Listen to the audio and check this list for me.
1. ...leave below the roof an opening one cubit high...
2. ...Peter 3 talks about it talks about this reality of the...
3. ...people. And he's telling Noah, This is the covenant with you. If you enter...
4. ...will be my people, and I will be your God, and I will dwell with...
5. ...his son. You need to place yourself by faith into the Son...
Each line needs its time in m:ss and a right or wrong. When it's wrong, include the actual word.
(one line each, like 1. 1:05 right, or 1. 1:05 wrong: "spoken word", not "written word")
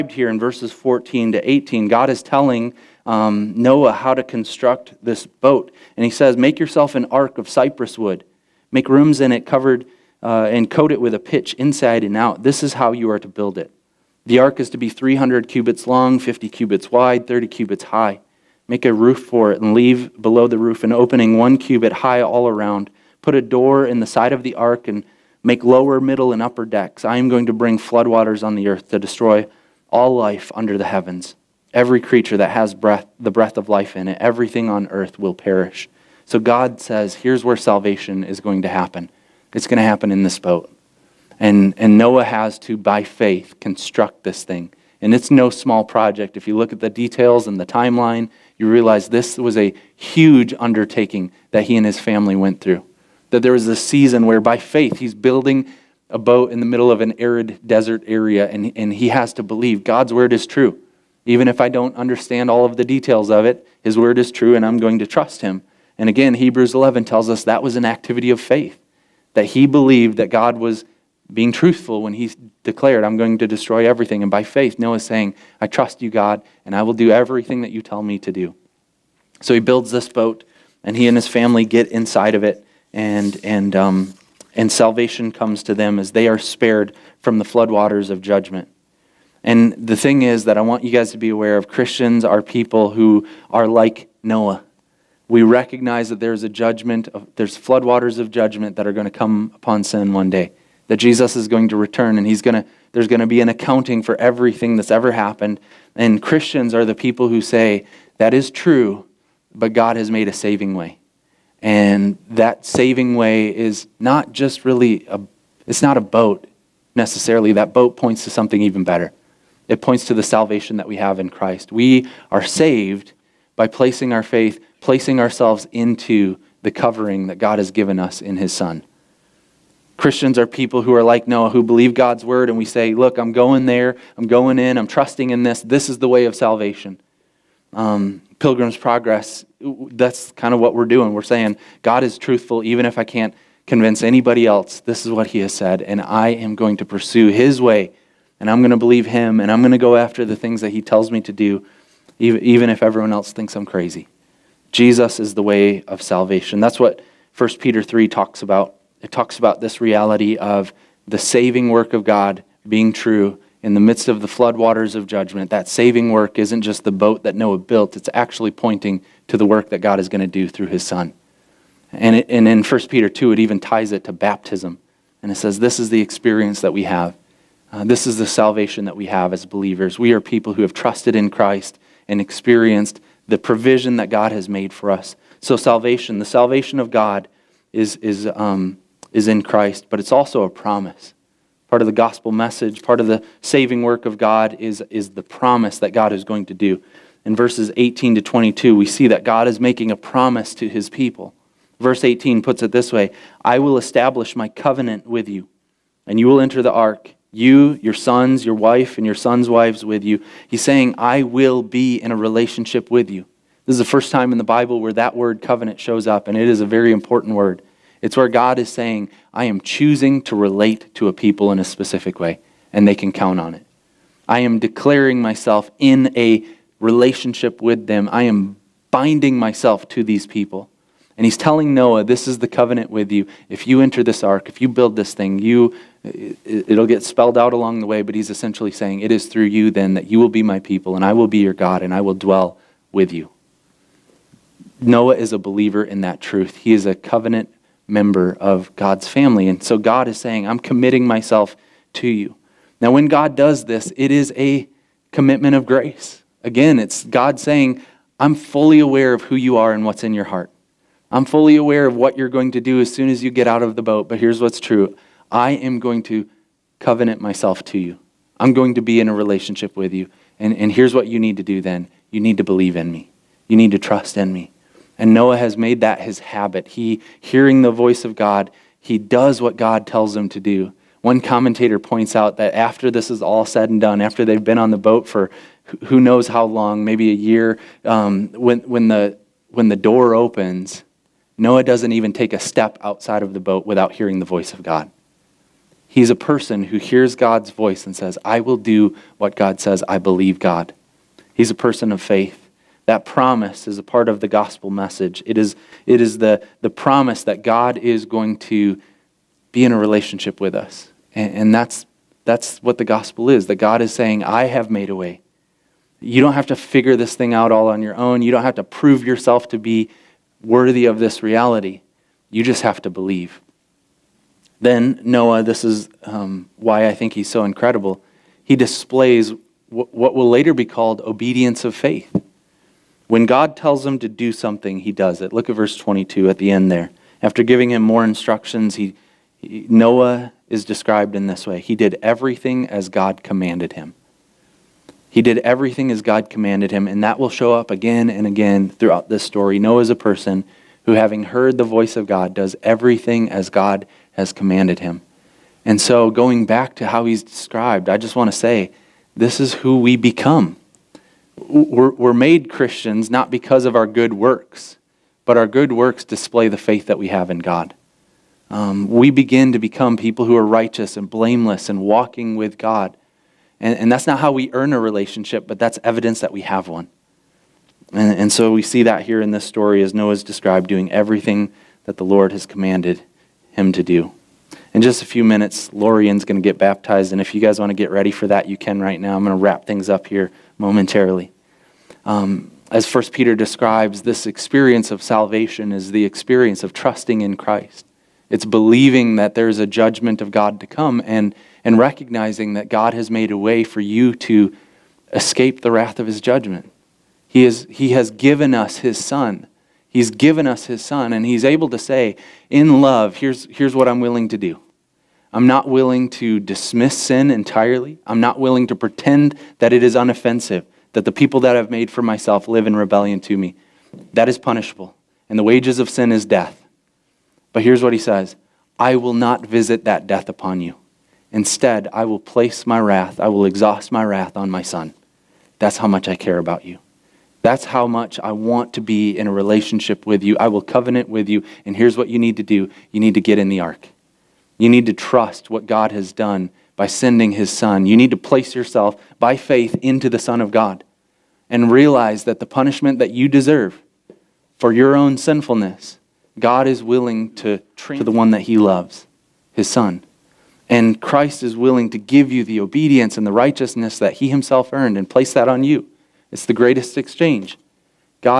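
1. 0:19 right
2. 2:37 right
3. 3:50 right
4. 4:00 right
5. 7:27 right.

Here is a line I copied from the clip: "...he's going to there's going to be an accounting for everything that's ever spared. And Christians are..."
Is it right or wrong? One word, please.
wrong.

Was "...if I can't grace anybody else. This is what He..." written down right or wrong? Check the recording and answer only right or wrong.
wrong.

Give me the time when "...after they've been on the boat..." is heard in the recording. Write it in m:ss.
4:44.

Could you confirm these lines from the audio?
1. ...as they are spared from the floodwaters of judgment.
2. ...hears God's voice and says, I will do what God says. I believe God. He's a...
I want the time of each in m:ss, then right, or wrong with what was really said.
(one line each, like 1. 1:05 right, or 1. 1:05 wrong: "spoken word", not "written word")
1. 1:25 right
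2. 4:56 right.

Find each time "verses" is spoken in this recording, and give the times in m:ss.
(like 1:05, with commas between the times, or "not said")
0:00, 3:17, 3:21, 5:35.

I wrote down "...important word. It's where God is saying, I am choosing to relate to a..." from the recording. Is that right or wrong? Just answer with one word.
right.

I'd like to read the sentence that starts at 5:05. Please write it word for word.
It is, it is the, the promise that God is going to be in a relationship with us.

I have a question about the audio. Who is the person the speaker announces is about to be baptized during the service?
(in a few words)
Lorian.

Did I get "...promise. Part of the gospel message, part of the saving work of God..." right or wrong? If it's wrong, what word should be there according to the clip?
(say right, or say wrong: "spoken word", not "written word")
right.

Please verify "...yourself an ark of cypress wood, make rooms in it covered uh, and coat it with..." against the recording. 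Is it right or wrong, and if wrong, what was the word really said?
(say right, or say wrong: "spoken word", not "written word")
right.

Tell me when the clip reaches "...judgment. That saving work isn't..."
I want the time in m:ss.
2:45.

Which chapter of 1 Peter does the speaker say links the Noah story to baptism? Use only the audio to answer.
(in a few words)
1 Peter 2.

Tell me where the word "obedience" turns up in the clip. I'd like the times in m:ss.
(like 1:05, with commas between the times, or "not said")
5:31, 7:42.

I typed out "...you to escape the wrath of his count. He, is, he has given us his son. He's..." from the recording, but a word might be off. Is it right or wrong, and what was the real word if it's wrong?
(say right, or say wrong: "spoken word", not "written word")
wrong: "judgment", not "count".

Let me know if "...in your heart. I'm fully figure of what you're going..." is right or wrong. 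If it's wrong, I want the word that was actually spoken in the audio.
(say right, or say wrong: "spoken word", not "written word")
wrong: "aware", not "figure".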